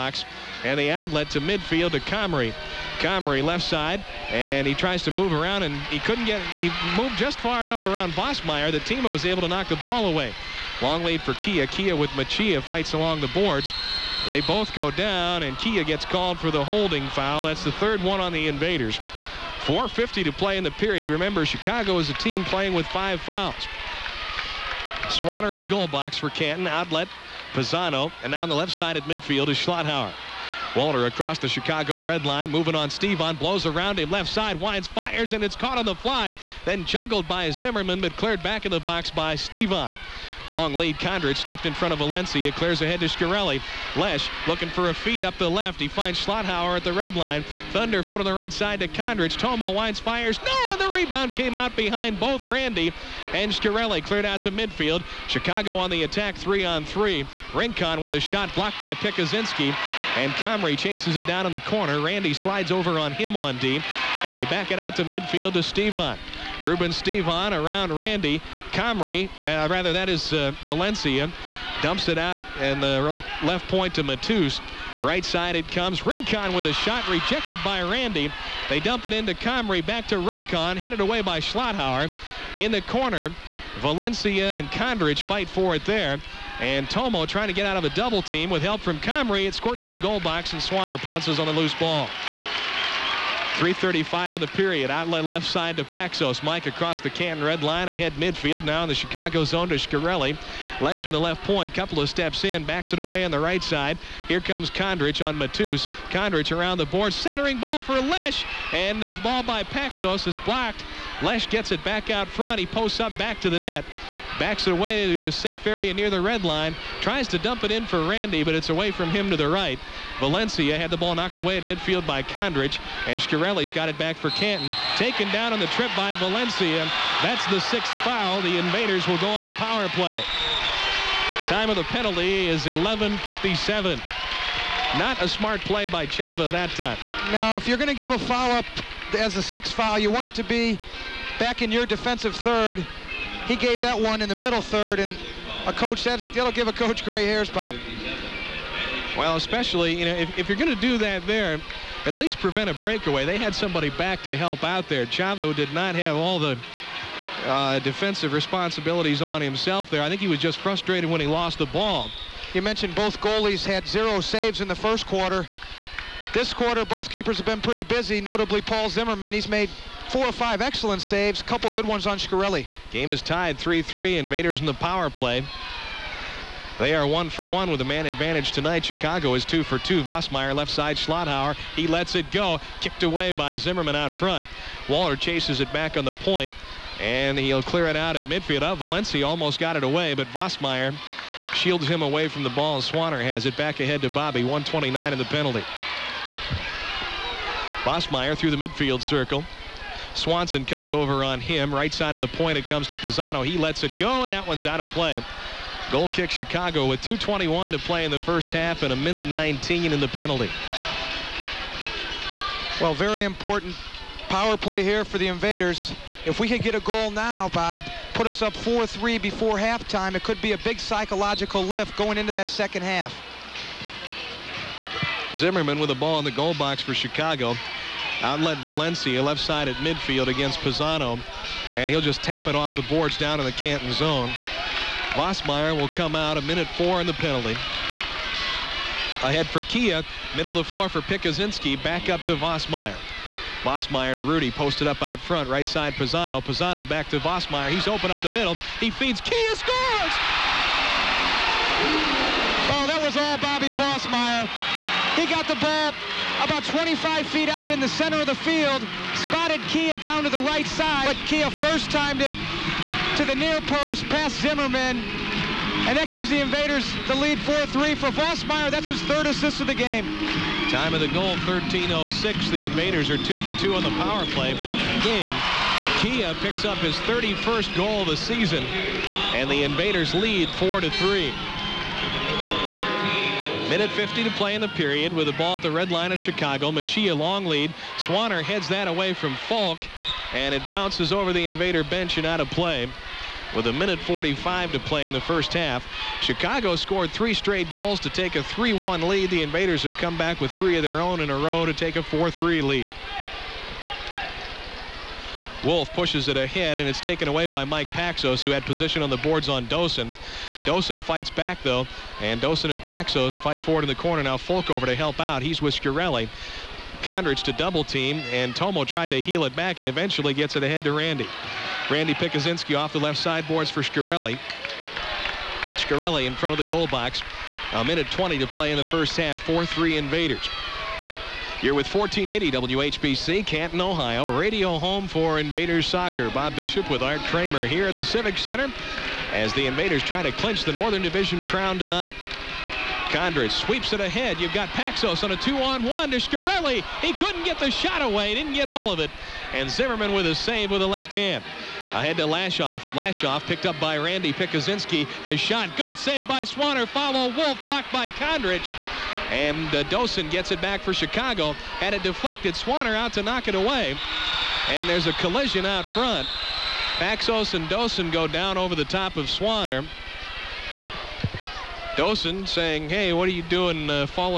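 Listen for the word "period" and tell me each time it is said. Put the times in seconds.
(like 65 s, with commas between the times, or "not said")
20 s, 94 s, 284 s.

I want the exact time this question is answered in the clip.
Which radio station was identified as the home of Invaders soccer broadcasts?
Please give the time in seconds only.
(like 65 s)
331 s.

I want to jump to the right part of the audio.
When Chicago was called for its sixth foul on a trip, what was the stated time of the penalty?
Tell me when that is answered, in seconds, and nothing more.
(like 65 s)
132 s.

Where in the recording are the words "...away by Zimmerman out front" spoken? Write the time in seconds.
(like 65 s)
183 s.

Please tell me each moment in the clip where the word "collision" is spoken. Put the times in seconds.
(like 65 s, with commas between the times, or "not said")
365 s.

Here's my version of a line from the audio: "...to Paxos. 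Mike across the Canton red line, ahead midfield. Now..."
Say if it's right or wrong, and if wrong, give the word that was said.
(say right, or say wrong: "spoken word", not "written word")
right.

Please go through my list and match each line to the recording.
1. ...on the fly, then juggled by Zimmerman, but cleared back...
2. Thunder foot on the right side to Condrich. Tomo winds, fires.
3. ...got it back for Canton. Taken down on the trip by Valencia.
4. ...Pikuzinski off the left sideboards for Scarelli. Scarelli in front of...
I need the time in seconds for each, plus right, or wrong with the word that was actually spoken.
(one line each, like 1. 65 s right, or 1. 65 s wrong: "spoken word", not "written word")
1. 35 s right
2. 47 s right
3. 123 s right
4. 322 s right.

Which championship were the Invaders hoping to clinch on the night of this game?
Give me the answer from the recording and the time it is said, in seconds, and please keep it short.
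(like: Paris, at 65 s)
Northern Division crown, at 340 s.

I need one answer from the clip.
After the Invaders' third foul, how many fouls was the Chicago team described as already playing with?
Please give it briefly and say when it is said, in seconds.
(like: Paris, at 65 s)
5, at 22 s.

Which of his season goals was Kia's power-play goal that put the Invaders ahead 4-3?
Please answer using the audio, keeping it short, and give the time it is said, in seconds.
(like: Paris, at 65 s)
31st, at 277 s.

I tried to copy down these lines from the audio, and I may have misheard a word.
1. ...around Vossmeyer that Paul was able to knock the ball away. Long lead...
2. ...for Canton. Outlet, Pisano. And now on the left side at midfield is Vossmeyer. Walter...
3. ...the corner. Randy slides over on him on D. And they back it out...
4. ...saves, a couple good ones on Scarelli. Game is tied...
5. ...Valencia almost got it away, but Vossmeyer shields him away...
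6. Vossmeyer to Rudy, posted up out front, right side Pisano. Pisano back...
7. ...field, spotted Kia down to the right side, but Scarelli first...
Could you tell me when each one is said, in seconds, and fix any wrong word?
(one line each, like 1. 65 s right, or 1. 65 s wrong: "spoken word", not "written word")
1. 7 s wrong: "Tima", not "Paul"
2. 26 s wrong: "Schlotthauer", not "Vossmeyer"
3. 61 s right
4. 171 s right
5. 188 s right
6. 243 s right
7. 258 s wrong: "Kia", not "Scarelli".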